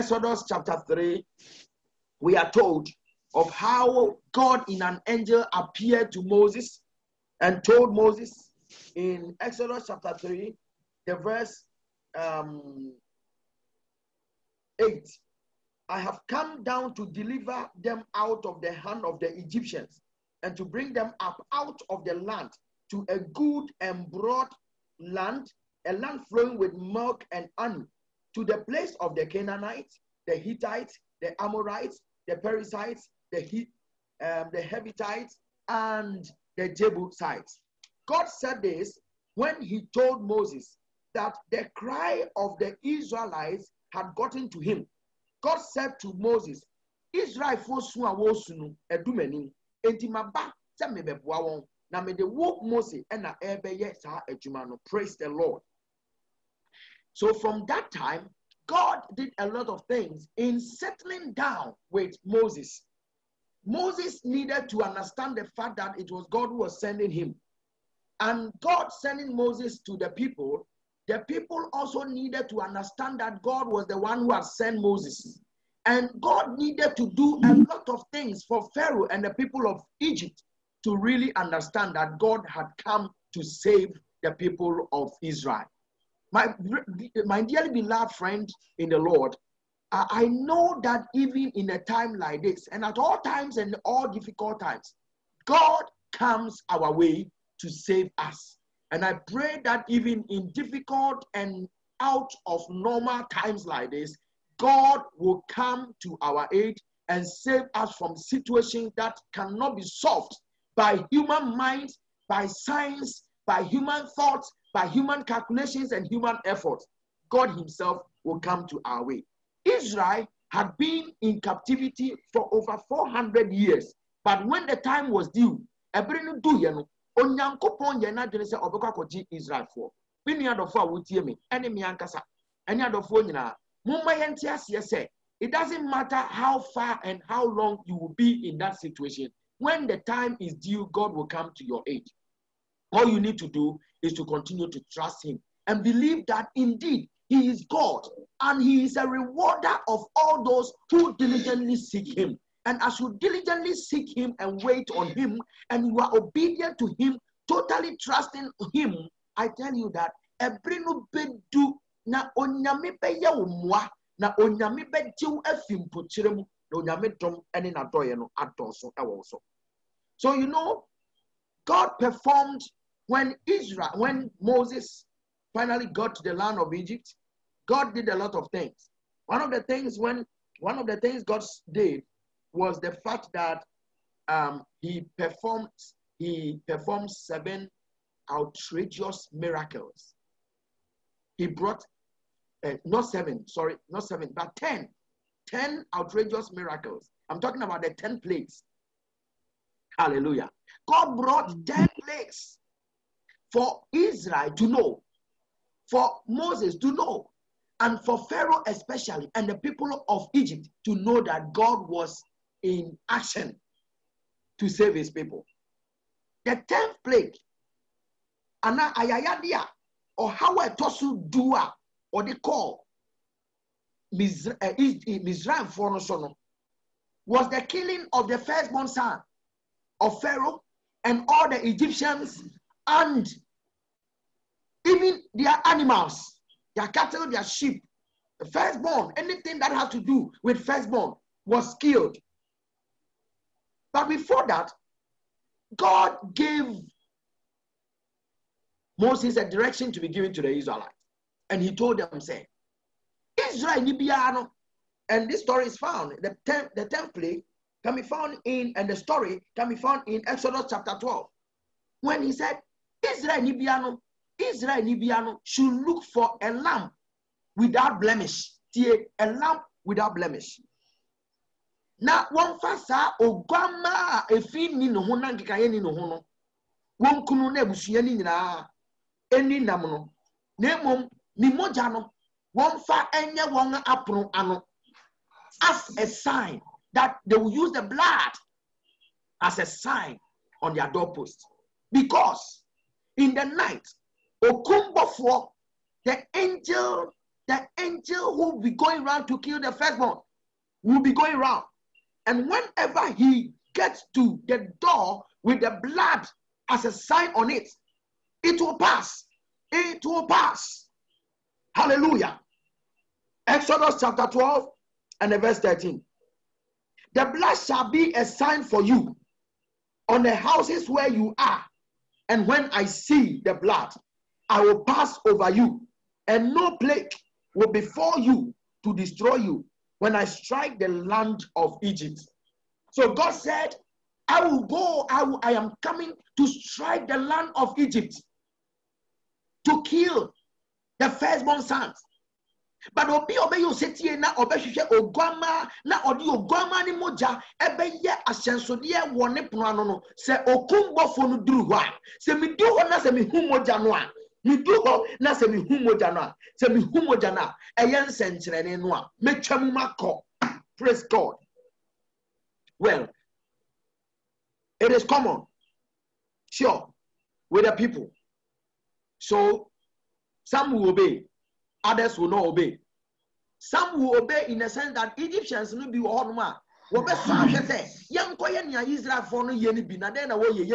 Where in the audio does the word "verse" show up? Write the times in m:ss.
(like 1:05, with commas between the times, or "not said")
0:11, 5:15.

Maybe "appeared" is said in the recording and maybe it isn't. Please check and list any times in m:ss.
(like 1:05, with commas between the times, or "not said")
0:05.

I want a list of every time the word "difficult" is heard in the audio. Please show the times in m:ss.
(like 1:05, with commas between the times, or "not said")
1:34, 1:40.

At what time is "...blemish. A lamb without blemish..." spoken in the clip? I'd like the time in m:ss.
4:28.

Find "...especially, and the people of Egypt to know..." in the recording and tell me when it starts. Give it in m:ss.
3:28.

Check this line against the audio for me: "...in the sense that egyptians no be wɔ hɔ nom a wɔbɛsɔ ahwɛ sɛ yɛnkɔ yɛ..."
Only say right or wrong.
right.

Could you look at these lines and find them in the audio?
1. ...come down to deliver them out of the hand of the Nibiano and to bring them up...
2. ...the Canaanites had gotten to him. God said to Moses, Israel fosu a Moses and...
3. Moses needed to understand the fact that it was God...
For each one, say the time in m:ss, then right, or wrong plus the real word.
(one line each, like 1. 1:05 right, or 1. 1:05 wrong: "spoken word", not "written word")
1. 0:16 wrong: "Egyptians", not "Nibiano"
2. 0:42 wrong: "Israelites", not "Canaanites"
3. 1:03 right.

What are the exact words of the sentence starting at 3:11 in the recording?
He brought uh, not seven, sorry, not seven, but ten, ten outrageous miracles.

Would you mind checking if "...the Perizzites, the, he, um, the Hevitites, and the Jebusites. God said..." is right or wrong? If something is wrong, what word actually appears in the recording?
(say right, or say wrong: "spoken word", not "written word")
right.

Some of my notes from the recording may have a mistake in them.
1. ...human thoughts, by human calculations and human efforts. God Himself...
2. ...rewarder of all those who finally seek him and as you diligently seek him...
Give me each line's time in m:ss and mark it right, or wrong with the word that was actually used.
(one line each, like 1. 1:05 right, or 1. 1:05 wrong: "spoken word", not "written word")
1. 1:53 right
2. 2:29 wrong: "diligently", not "finally".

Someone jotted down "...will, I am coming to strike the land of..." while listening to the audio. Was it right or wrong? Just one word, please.
right.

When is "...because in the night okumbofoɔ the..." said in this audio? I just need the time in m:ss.
4:51.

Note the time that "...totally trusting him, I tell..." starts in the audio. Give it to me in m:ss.
2:37.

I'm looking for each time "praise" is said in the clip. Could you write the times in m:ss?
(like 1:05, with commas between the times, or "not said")
0:54, 6:00.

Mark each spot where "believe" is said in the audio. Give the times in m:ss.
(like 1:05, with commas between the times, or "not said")
2:25.